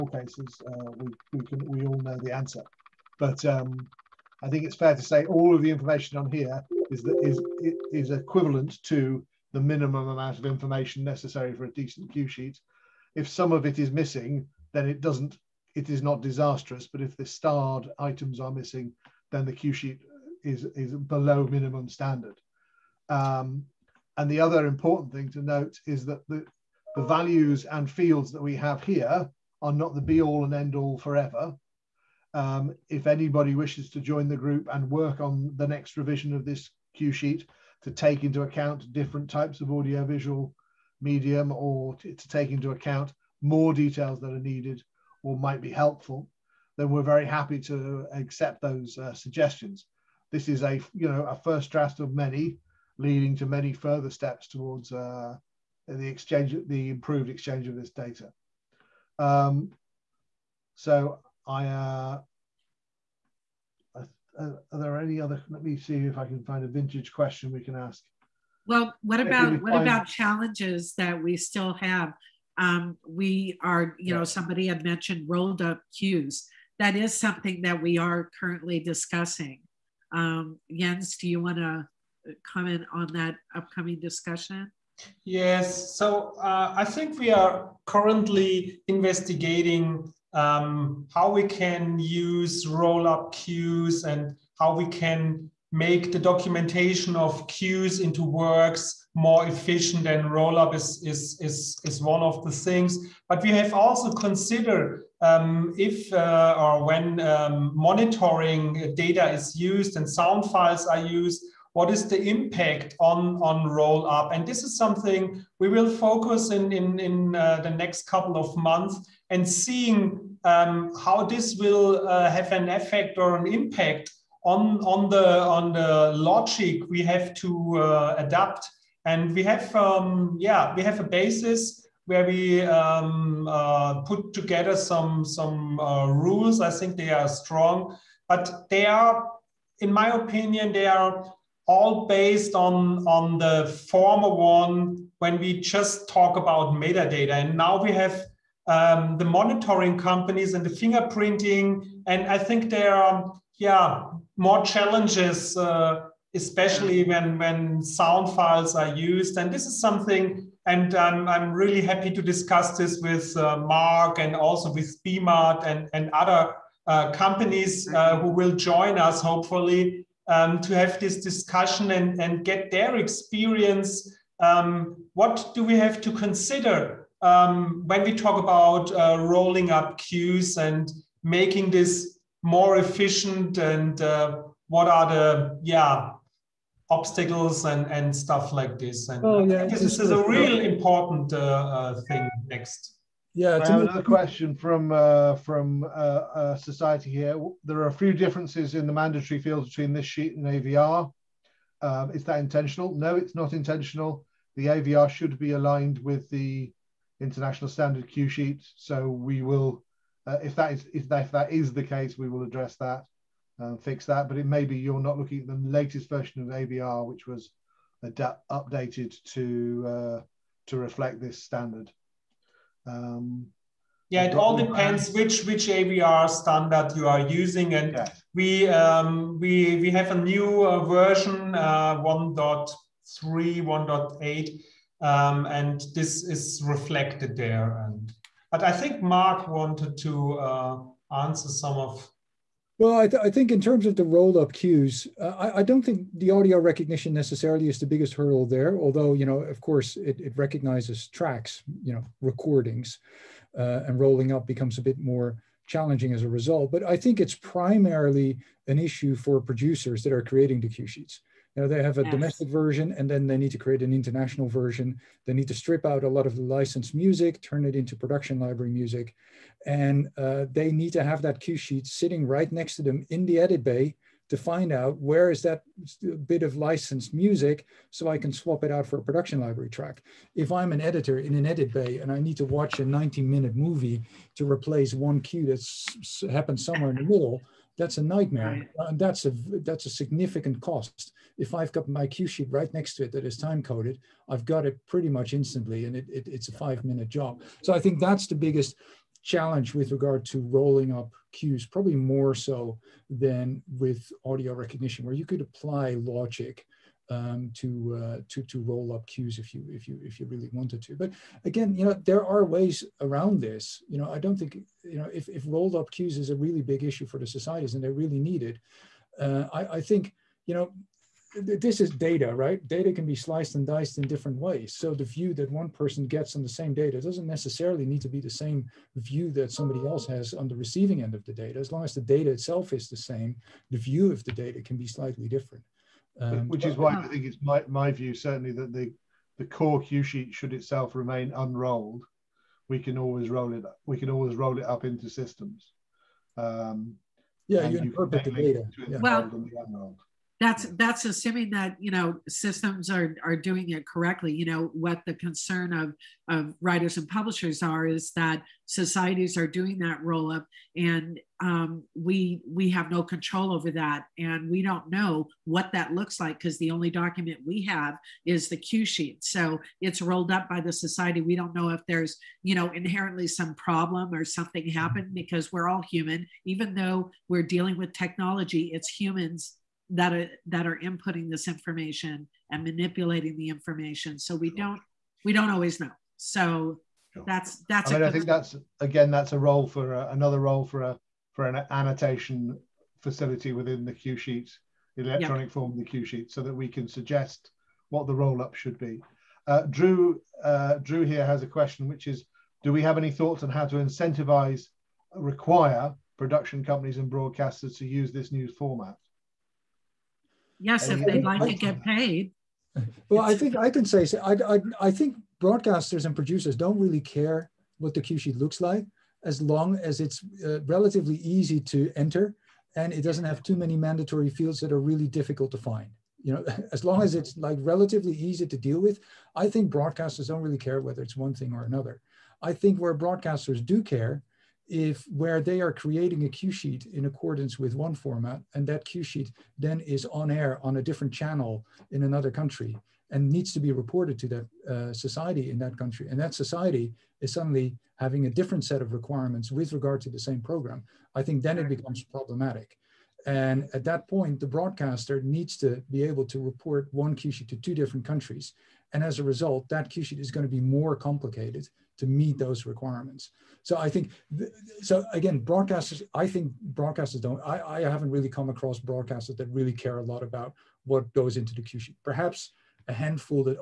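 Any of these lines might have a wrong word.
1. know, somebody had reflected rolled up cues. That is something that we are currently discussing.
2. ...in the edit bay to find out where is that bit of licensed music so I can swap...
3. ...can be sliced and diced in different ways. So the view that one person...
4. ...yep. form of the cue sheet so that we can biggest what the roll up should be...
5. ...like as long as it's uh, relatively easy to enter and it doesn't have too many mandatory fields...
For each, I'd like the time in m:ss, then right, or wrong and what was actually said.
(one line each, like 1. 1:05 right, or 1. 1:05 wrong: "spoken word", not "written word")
1. 1:14 wrong: "mentioned", not "reflected"
2. 4:33 right
3. 5:22 right
4. 6:35 wrong: "suggest", not "biggest"
5. 6:58 right.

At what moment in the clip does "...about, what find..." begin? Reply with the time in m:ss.
1:09.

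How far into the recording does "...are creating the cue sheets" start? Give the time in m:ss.
4:20.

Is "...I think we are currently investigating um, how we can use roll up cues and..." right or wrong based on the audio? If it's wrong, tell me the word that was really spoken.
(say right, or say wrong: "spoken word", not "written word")
right.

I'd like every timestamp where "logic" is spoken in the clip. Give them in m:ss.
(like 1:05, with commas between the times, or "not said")
2:06, 5:06.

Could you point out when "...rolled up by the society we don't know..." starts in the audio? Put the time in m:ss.
6:10.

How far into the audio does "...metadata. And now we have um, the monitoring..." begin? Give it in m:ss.
2:26.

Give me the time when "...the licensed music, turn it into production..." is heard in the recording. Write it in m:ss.
4:26.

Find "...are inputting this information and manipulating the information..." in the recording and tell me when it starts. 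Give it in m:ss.
6:20.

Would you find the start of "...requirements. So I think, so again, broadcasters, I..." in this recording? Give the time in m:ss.
7:42.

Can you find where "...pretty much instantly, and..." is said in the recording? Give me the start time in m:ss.
4:54.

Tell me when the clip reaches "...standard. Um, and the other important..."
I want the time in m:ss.
0:21.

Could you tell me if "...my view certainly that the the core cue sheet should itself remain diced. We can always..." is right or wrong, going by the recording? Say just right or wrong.
wrong.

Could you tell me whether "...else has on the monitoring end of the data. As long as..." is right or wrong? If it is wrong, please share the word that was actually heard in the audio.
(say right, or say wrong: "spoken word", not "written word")
wrong: "receiving", not "monitoring".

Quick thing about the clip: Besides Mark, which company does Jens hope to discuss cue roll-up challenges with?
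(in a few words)
BMAT.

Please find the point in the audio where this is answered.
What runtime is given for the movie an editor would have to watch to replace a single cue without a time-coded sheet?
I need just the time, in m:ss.
4:42.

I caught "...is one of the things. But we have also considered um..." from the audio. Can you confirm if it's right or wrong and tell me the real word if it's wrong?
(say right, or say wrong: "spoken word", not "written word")
right.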